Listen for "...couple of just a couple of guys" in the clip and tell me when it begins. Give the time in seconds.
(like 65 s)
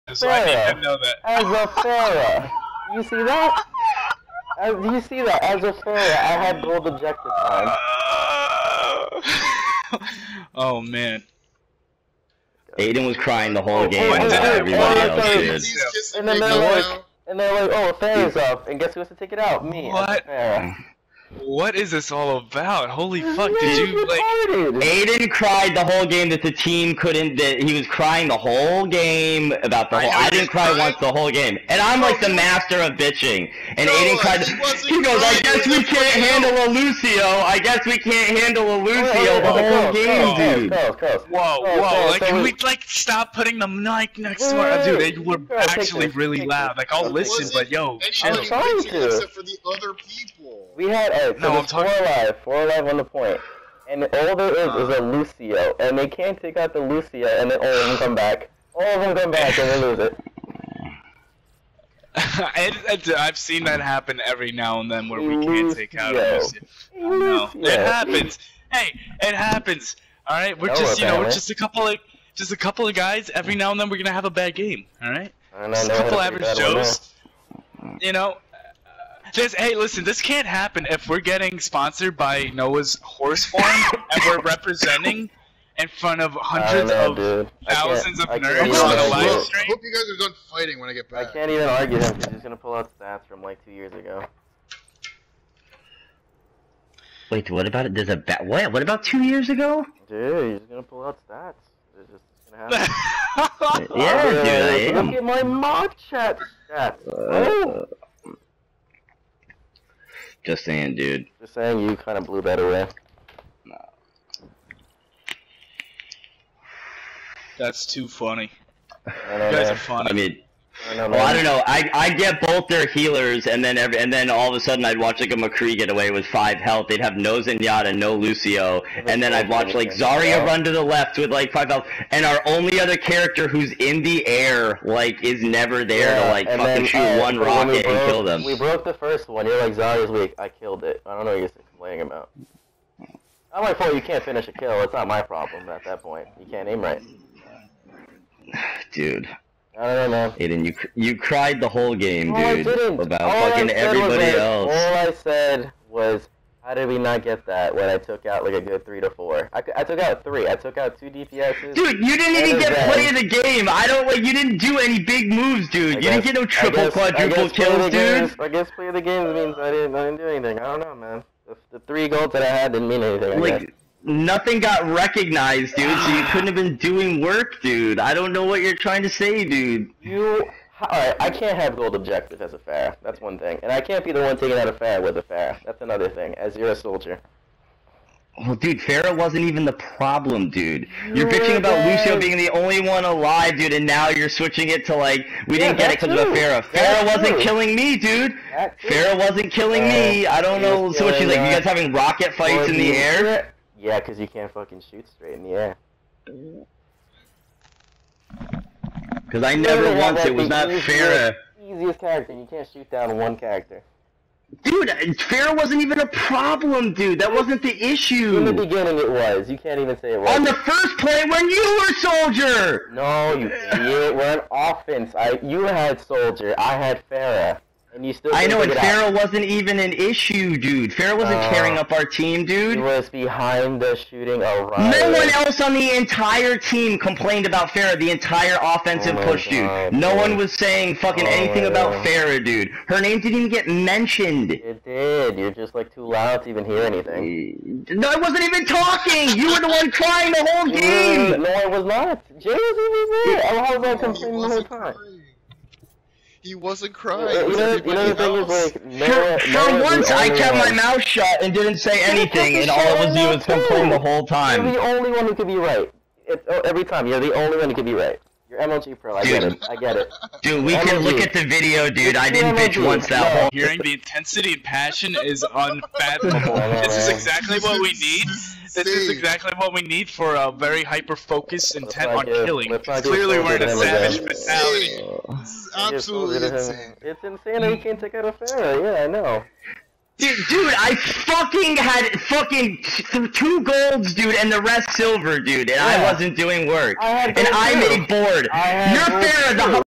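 71 s.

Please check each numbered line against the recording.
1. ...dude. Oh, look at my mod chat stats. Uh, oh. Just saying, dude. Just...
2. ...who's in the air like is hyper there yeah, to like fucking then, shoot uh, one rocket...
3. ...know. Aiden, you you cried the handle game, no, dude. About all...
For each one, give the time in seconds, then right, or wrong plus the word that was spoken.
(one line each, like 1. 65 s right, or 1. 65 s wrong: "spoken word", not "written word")
1. 104 s right
2. 133 s wrong: "never", not "hyper"
3. 150 s wrong: "whole", not "handle".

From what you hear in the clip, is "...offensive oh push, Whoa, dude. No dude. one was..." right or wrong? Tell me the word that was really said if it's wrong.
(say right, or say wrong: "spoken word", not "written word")
wrong: "God", not "Whoa".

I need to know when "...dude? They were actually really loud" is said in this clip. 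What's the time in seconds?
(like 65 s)
44 s.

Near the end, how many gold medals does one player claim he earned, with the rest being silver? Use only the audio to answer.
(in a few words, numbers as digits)
2.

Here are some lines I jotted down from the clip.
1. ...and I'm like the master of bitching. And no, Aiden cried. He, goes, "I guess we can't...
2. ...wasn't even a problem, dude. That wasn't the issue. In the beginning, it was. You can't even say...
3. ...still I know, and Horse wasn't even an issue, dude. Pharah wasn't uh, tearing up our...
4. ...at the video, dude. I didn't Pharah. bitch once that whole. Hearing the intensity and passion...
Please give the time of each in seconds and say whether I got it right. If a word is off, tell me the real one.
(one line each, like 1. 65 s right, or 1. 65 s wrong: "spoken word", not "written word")
1. 31 s right
2. 215 s right
3. 228 s wrong: "Pharah", not "Horse"
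4. 271 s wrong: "MLG", not "Pharah".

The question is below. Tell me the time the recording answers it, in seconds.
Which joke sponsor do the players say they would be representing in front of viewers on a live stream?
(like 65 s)
82 s.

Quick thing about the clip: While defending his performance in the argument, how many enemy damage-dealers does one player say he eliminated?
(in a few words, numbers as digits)
2.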